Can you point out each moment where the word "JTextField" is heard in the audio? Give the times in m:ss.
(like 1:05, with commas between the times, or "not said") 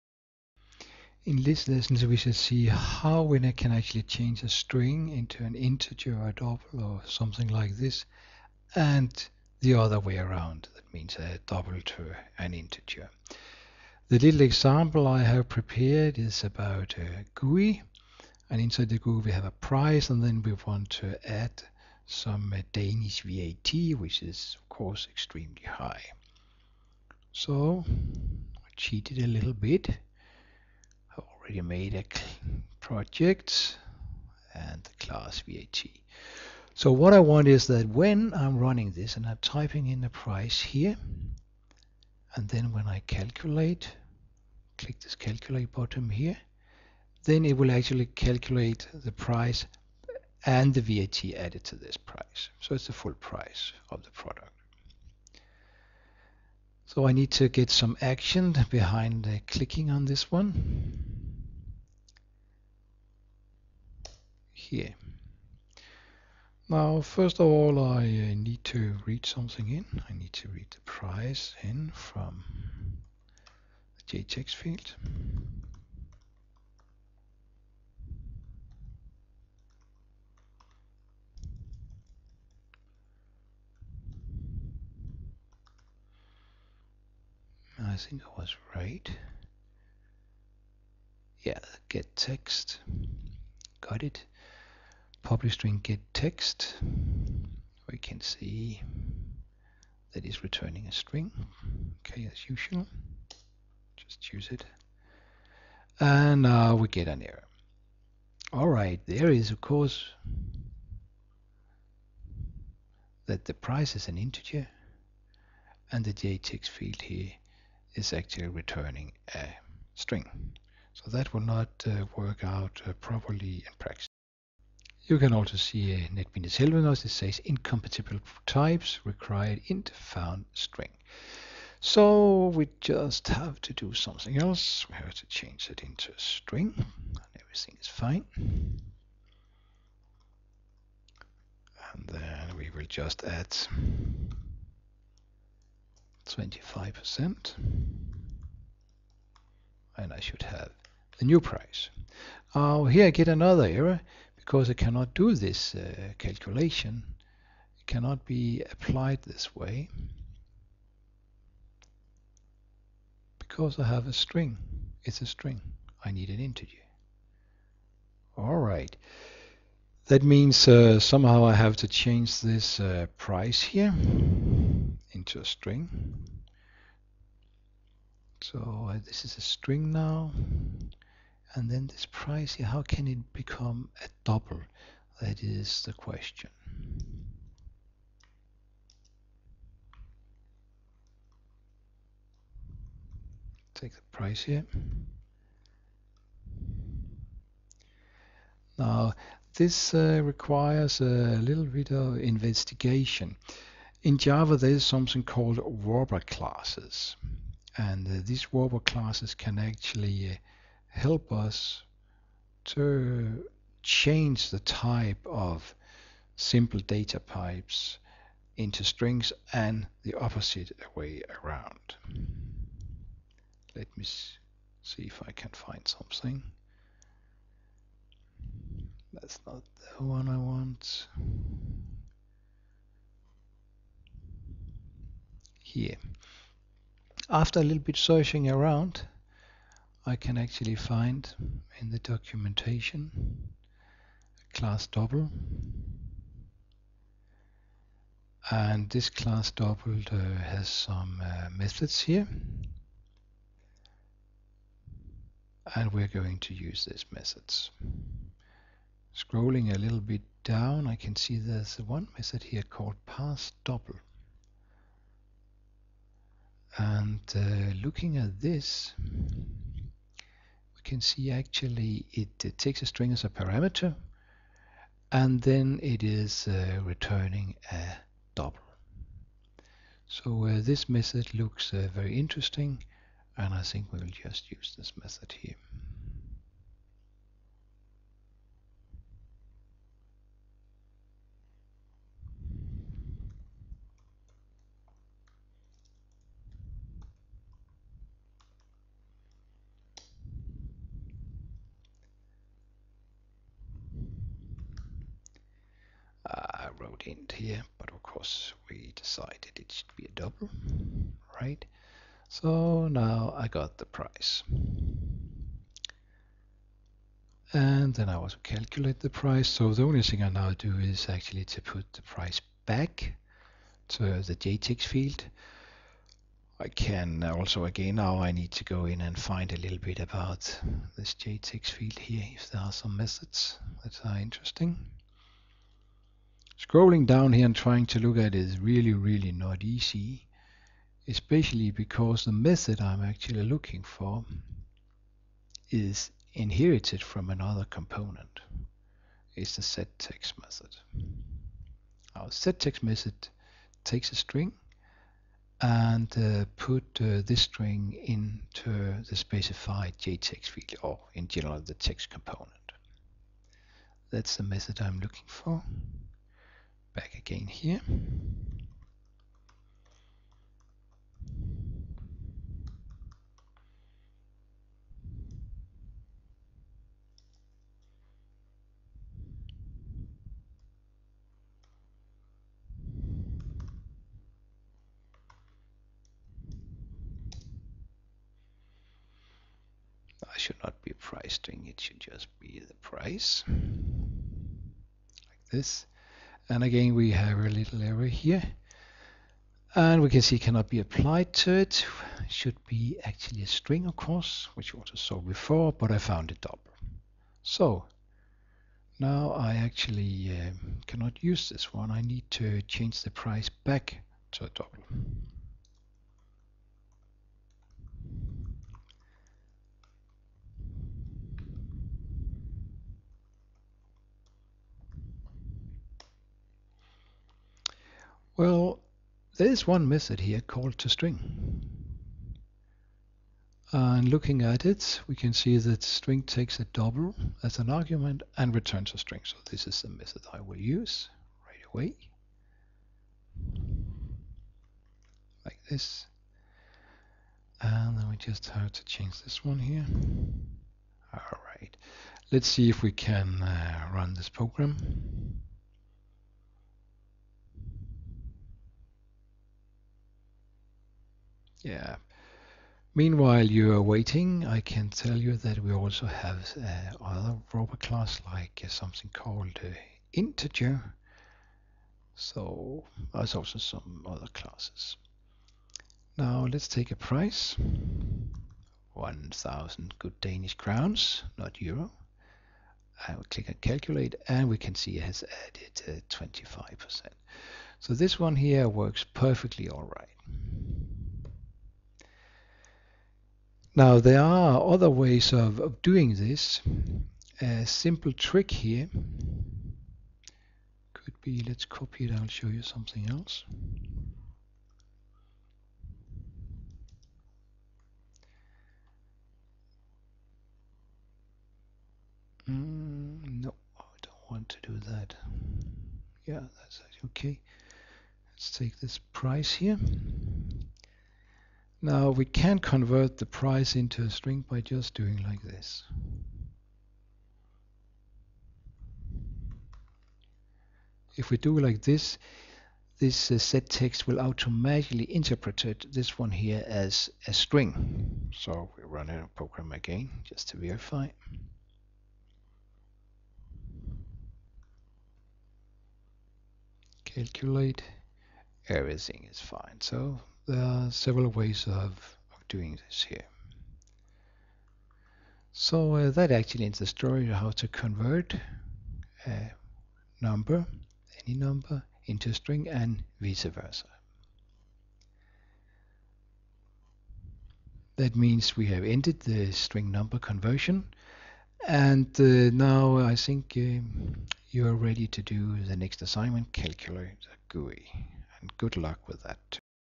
1:14, 1:56, 5:24, 5:31, 5:59.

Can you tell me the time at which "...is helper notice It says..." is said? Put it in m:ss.
2:06.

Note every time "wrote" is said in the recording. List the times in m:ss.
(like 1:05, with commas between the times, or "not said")
not said.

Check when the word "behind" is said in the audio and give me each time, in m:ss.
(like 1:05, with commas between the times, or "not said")
0:58.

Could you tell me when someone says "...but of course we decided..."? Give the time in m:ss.
5:07.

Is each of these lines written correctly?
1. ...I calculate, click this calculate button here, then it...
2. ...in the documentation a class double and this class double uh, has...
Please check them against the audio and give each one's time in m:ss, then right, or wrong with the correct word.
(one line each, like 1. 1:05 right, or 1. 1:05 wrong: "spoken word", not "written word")
1. 0:42 right
2. 4:01 right.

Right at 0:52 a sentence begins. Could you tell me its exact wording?
So it's the full price of the product.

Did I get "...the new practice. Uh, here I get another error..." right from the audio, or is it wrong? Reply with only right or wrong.
wrong.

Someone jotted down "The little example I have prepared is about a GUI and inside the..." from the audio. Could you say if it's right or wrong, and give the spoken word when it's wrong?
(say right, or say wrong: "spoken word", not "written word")
right.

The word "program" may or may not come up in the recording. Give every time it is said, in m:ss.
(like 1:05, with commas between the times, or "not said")
7:34, 8:59.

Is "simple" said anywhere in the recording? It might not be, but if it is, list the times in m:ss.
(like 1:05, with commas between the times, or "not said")
3:36, 8:17.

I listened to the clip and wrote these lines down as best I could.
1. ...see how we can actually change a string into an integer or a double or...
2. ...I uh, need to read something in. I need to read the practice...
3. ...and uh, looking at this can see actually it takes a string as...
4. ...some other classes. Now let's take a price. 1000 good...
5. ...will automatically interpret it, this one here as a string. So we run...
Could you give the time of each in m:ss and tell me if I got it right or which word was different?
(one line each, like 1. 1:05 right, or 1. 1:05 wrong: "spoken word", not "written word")
1. 0:02 right
2. 1:07 wrong: "price", not "practice"
3. 4:26 right
4. 7:53 right
5. 8:54 right.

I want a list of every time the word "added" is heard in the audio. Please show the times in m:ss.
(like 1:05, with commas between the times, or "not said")
0:51, 8:05.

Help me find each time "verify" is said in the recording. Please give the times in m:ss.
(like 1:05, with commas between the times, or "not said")
9:00.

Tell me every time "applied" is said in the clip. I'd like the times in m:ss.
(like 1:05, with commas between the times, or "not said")
2:38, 6:40.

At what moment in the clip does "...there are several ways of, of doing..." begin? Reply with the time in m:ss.
9:10.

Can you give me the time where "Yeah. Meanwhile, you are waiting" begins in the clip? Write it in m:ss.
7:41.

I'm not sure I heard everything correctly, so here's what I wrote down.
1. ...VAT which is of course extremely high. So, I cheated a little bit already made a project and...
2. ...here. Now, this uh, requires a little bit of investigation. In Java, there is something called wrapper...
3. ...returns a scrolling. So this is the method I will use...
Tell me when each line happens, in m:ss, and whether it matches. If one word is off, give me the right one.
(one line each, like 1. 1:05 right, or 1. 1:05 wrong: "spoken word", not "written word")
1. 0:23 right
2. 3:14 right
3. 7:18 wrong: "string", not "scrolling".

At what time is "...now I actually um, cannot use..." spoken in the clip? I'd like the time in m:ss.
6:48.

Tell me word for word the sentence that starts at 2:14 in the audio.
We have to change it into a string and everything is fine.